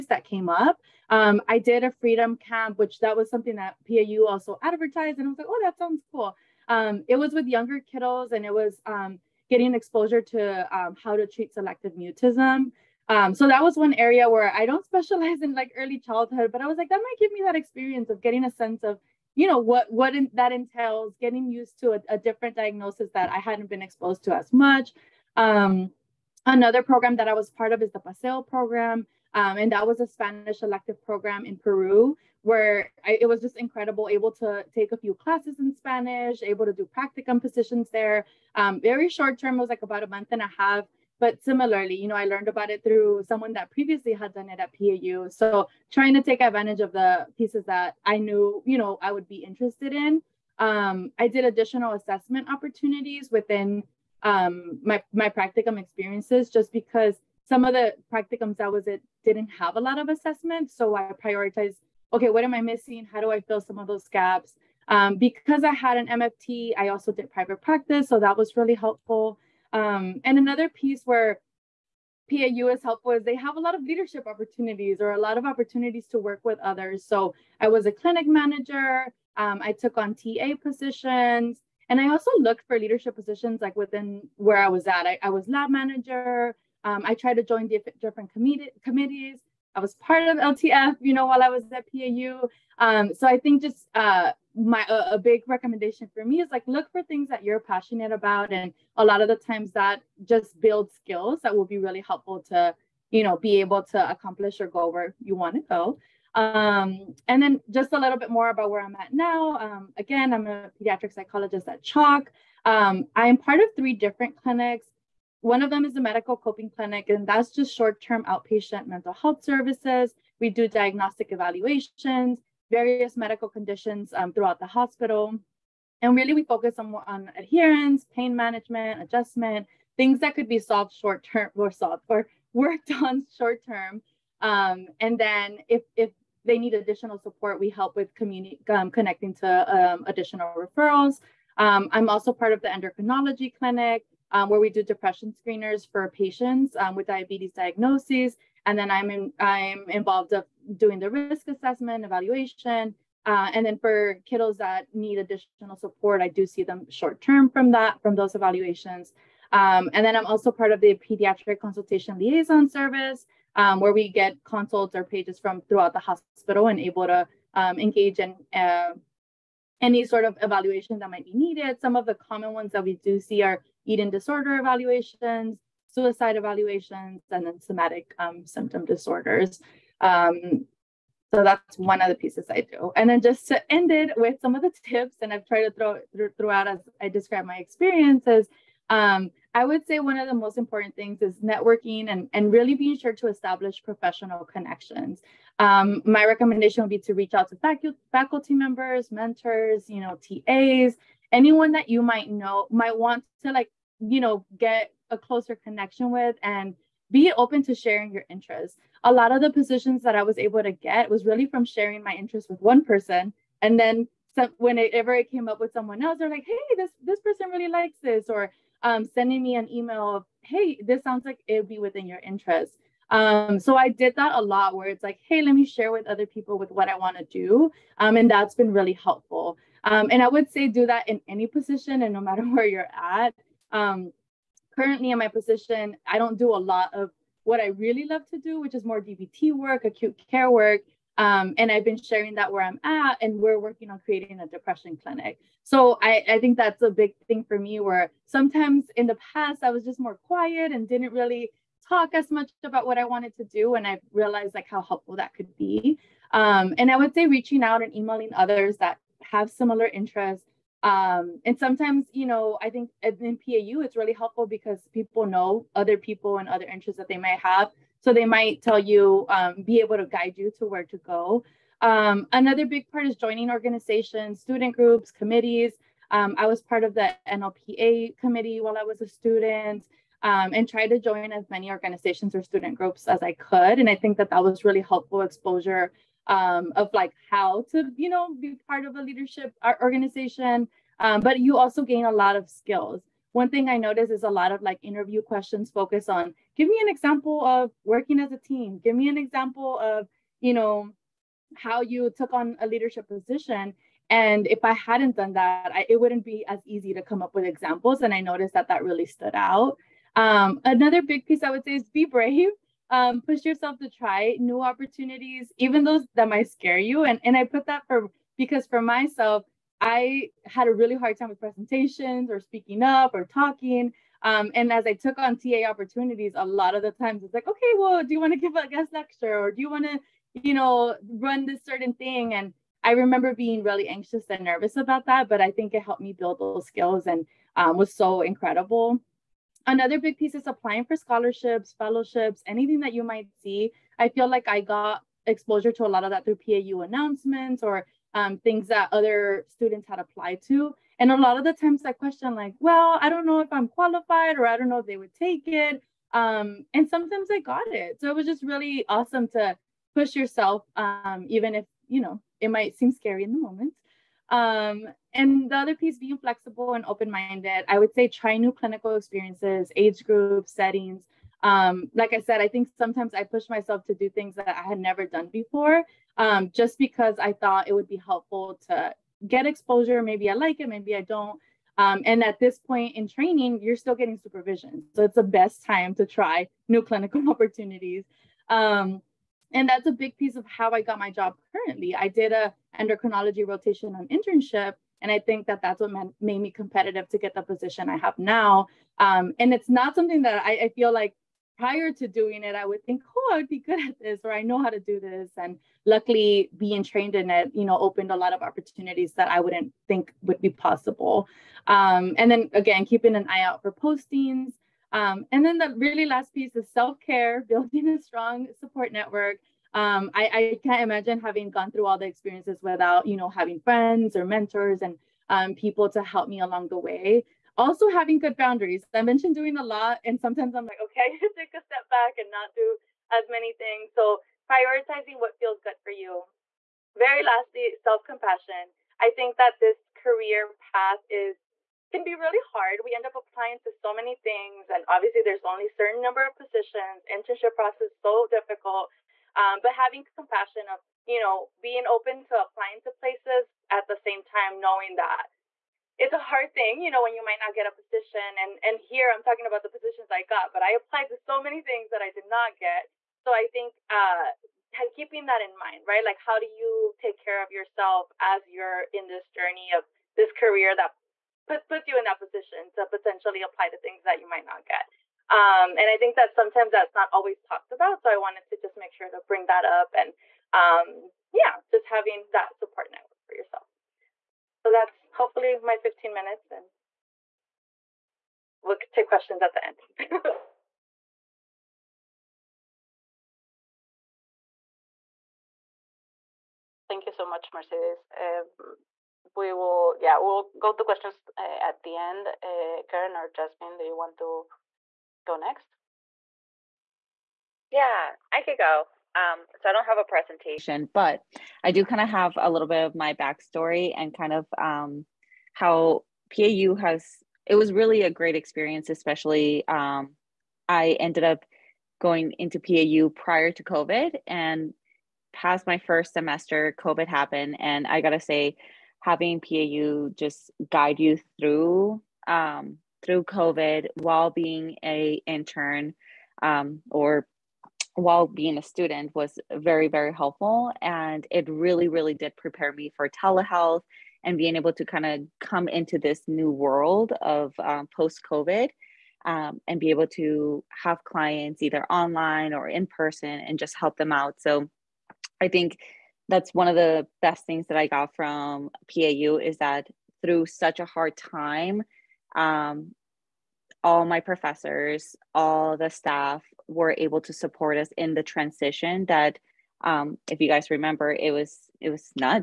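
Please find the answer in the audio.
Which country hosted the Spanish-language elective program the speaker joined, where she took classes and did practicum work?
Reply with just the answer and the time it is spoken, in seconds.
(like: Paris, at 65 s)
Peru, at 31 s.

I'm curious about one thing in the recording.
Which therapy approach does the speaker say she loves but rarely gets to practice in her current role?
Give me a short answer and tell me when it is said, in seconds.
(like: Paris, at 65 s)
DBT, at 239 s.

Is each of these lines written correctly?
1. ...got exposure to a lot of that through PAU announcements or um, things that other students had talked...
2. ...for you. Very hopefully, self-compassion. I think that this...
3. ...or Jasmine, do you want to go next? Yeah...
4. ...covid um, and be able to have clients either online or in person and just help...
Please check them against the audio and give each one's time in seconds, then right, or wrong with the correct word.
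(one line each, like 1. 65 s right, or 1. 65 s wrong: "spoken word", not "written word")
1. 344 s wrong: "applied", not "talked"
2. 435 s wrong: "lastly", not "hopefully"
3. 503 s right
4. 548 s right.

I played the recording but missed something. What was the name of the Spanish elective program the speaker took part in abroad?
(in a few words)
Paseo.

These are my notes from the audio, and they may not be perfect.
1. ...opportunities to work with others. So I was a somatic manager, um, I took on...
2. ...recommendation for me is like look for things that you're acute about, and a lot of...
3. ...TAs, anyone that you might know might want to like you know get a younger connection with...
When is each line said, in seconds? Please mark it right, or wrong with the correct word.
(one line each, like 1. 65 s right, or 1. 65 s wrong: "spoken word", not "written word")
1. 75 s wrong: "clinic", not "somatic"
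2. 95 s wrong: "passionate", not "acute"
3. 200 s wrong: "closer", not "younger".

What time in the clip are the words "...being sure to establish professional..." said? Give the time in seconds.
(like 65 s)
192 s.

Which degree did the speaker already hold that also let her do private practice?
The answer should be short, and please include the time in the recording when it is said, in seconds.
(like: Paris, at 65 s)
MFT, at 66 s.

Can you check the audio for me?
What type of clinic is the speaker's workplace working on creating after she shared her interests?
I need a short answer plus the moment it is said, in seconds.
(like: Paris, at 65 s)
depression clinic, at 244 s.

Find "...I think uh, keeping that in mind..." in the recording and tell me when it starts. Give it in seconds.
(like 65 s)
463 s.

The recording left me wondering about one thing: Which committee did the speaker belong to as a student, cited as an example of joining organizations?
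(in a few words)
NLPA.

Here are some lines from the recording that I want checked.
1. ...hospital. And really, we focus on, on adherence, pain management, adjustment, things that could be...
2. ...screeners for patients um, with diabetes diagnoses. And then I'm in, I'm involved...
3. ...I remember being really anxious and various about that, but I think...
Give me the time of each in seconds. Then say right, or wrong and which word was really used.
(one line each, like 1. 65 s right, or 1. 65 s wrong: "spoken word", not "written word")
1. 124 s right
2. 145 s right
3. 332 s wrong: "nervous", not "various".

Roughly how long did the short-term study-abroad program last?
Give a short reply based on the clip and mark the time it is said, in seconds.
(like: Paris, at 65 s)
a month and a half, at 39 s.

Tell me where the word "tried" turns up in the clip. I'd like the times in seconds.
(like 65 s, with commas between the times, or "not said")
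87 s, 185 s, 280 s.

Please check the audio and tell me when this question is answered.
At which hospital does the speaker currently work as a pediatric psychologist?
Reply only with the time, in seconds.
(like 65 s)
111 s.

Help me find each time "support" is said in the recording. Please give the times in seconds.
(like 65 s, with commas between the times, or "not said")
137 s, 155 s, 418 s, 482 s, 567 s.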